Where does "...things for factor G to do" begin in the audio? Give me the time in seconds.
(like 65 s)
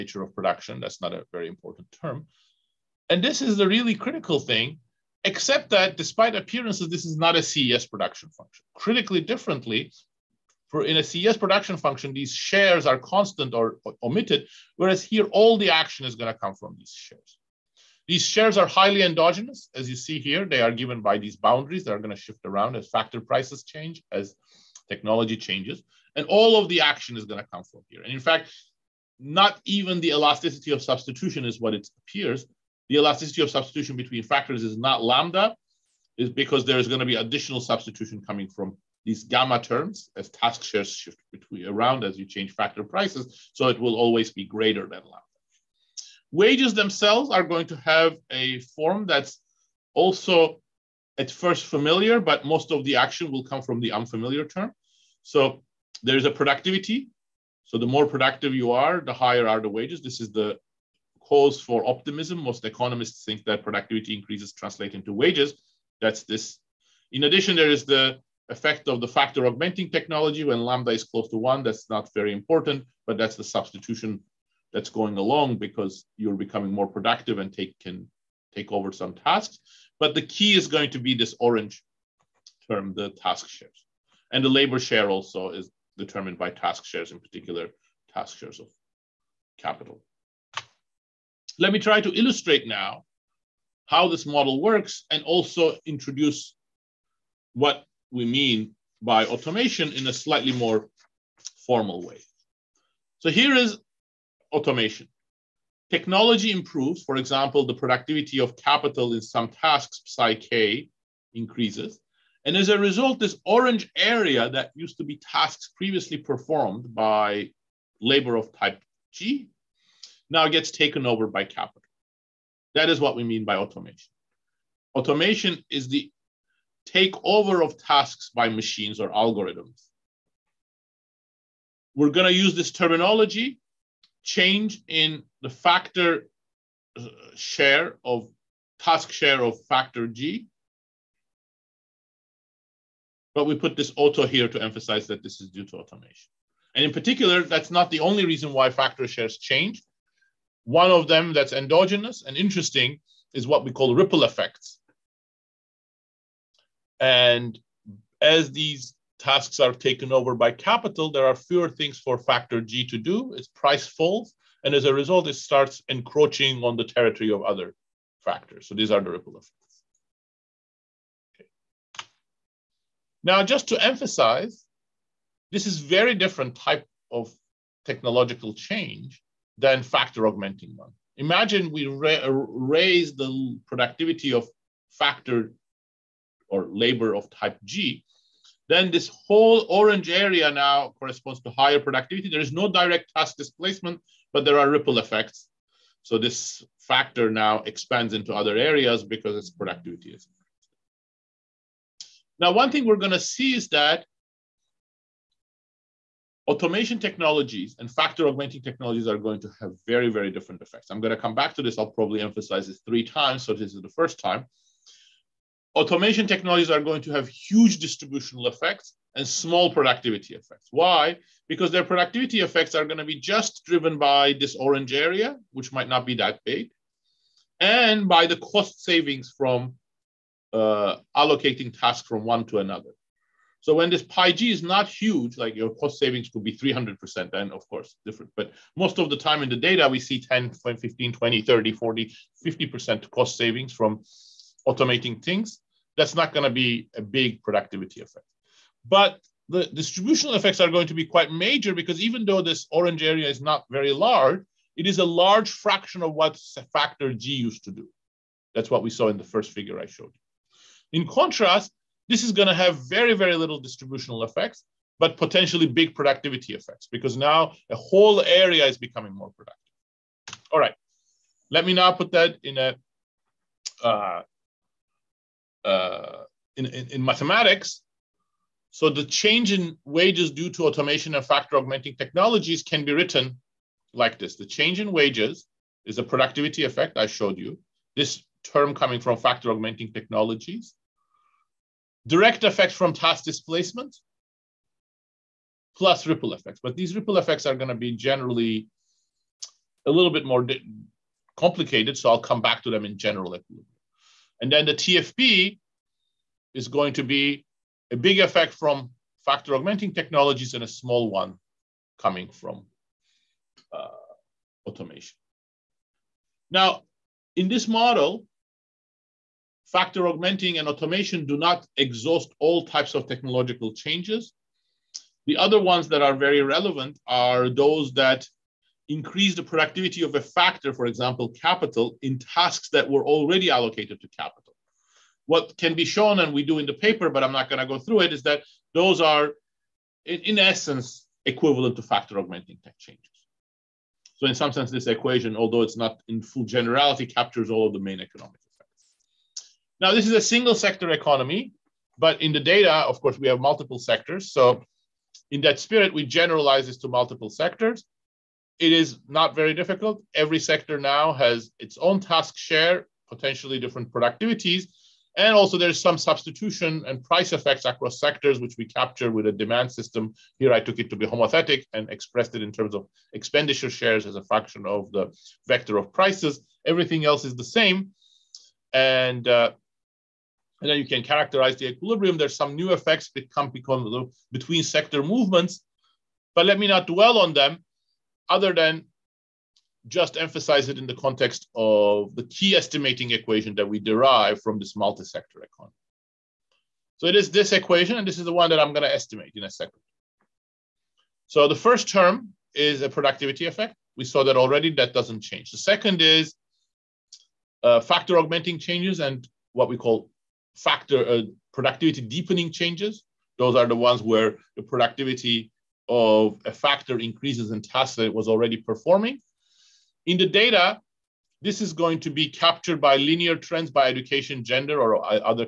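161 s.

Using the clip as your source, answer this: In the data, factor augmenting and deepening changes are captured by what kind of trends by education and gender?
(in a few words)
linear trends.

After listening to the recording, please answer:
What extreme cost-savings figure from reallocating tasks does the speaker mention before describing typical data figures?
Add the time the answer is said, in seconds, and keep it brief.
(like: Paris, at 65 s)
300%, at 236 s.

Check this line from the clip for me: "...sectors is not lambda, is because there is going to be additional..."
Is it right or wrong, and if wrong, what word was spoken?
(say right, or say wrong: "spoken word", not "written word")
wrong: "factors", not "sectors".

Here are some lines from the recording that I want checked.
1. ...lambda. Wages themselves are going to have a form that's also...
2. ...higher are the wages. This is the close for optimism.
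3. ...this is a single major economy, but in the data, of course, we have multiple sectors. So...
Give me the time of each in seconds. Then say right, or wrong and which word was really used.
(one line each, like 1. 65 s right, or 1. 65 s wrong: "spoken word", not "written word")
1. 45 s right
2. 59 s wrong: "cause", not "close"
3. 349 s wrong: "sector", not "major".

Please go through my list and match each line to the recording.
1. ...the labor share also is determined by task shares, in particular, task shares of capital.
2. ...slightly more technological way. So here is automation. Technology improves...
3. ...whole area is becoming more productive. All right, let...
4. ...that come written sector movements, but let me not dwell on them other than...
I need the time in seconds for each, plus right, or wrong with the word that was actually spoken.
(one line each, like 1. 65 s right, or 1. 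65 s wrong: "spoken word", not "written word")
1. 84 s right
2. 100 s wrong: "formal", not "technological"
3. 267 s right
4. 383 s wrong: "between", not "written".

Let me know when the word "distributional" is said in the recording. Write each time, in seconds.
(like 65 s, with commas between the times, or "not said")
217 s, 249 s, 263 s.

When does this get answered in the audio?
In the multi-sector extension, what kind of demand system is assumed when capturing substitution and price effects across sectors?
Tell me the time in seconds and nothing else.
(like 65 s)
371 s.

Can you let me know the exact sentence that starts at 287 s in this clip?
This term coming from factor augmenting technologies.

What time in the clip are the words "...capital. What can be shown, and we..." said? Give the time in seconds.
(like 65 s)
334 s.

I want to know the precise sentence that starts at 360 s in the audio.
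Every sector now has its own task share, potentially different productivities.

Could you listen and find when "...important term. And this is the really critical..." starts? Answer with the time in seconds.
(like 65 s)
1 s.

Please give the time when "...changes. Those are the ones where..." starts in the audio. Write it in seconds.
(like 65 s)
412 s.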